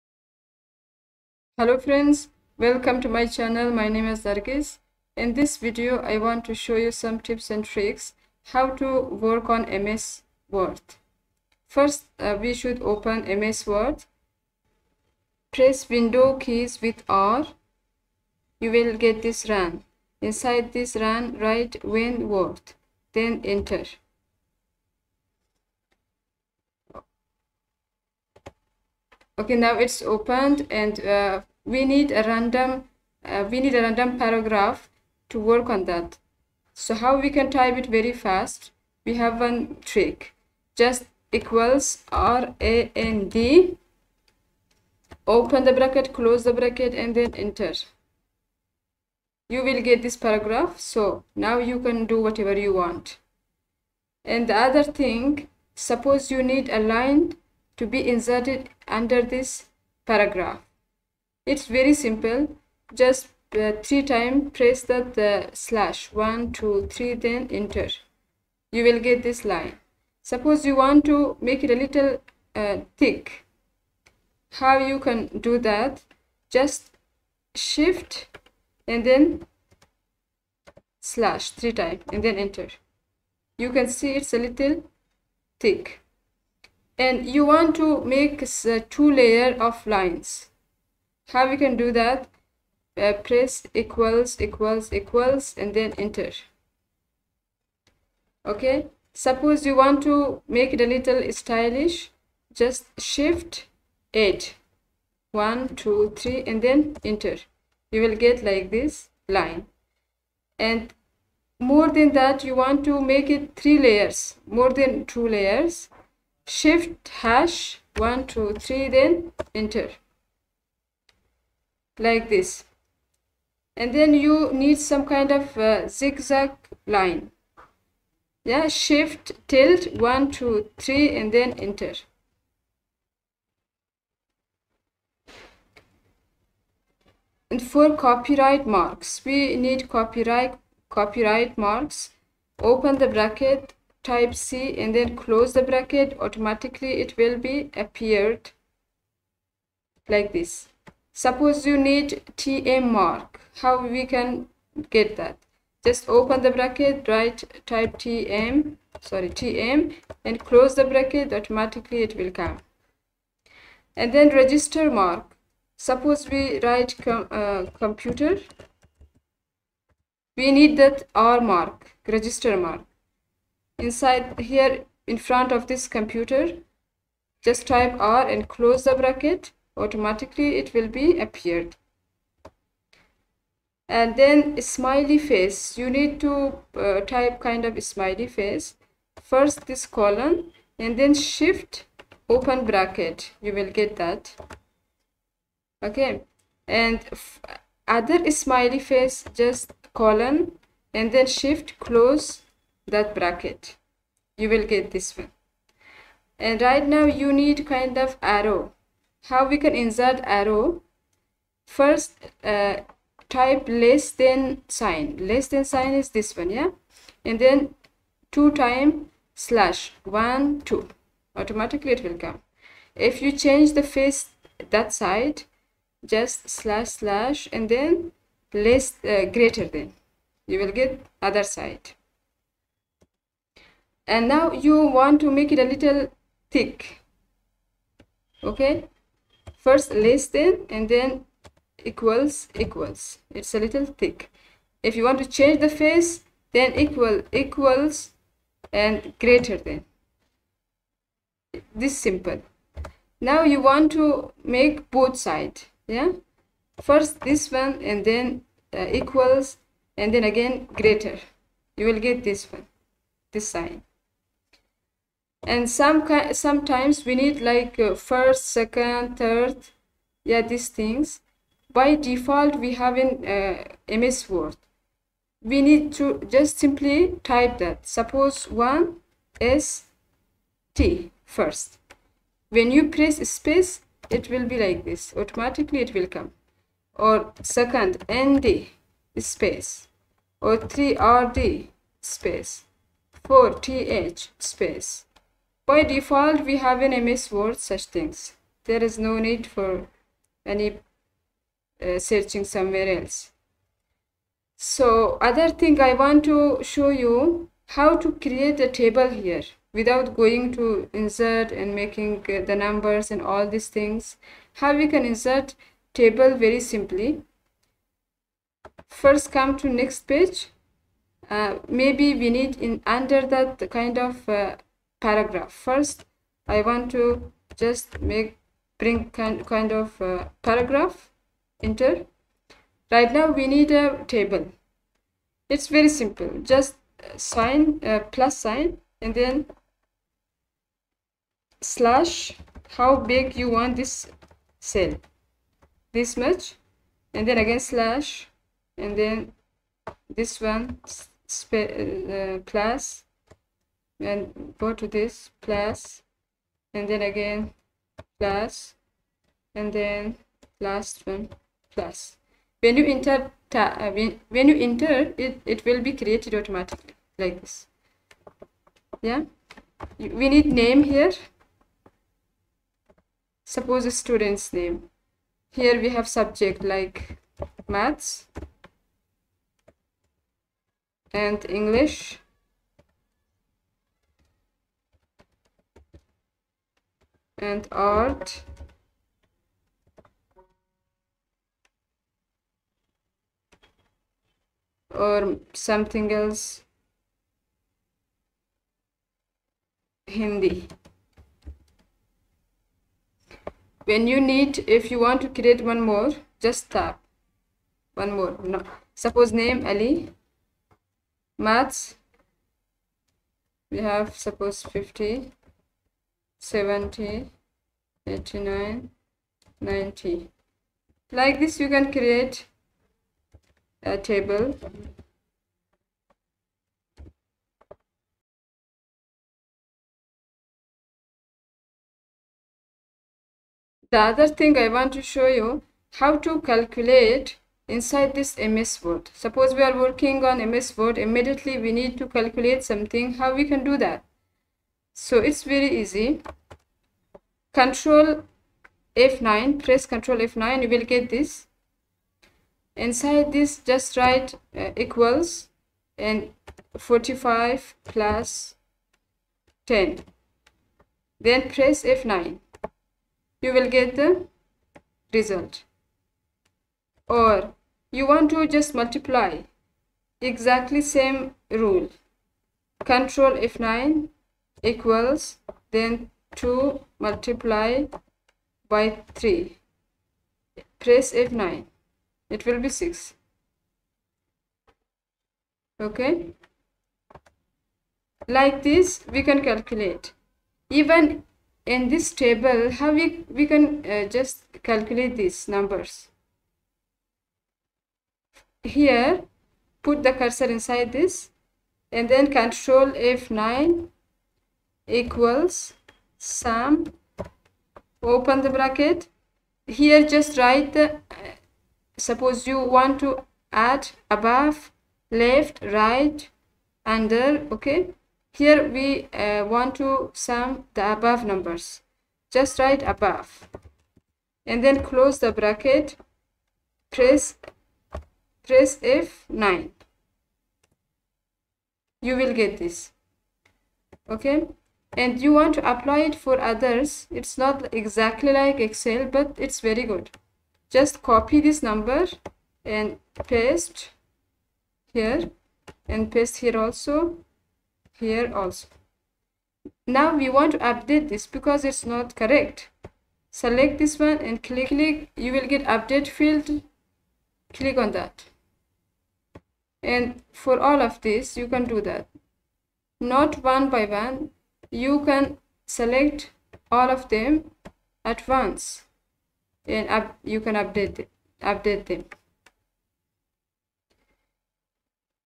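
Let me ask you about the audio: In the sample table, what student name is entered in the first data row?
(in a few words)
Ali.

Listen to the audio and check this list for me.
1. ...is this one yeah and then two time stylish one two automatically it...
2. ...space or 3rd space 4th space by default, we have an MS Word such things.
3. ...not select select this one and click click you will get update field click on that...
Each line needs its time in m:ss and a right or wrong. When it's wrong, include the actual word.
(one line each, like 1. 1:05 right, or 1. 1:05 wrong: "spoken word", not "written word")
1. 3:35 wrong: "slash", not "stylish"
2. 4:49 right
3. 9:11 wrong: "correct", not "select".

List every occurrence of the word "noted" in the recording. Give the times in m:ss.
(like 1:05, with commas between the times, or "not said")
not said.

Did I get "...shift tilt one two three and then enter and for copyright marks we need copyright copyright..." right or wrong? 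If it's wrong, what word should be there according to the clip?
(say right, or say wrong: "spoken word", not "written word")
right.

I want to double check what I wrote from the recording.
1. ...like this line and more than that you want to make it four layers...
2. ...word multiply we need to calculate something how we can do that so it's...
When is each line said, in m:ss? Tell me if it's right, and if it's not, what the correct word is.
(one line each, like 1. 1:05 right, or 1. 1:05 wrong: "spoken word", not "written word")
1. 1:48 wrong: "three", not "four"
2. 7:20 wrong: "immediately", not "multiply".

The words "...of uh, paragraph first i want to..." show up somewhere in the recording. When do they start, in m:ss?
5:23.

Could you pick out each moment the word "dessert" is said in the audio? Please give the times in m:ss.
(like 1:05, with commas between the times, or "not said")
not said.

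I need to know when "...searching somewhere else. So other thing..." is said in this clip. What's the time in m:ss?
5:01.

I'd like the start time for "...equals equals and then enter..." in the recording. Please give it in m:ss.
1:34.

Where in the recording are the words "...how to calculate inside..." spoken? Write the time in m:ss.
7:15.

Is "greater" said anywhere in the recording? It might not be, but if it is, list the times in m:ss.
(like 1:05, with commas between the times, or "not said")
3:49, 4:09, 4:20.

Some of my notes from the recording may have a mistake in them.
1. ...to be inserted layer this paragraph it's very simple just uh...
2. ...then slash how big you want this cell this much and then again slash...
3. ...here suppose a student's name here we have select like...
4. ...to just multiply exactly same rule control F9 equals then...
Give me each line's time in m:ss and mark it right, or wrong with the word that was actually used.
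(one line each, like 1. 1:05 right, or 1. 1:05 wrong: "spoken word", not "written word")
1. 0:57 wrong: "under", not "layer"
2. 5:39 right
3. 6:10 wrong: "subject", not "select"
4. 7:48 right.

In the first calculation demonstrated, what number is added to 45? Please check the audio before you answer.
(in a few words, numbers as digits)
10.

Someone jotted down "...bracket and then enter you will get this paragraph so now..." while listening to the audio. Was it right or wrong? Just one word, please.
right.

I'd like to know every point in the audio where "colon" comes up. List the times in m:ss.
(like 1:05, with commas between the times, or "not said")
3:09, 3:19.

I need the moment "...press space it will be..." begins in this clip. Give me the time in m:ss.
4:42.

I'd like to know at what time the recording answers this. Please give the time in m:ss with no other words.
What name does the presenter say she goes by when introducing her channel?
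0:04.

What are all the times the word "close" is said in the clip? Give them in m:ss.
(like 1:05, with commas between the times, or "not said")
0:46, 2:25, 2:40, 2:58, 3:21, 8:44.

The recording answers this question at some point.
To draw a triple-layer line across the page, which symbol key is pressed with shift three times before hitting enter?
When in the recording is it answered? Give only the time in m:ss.
1:57.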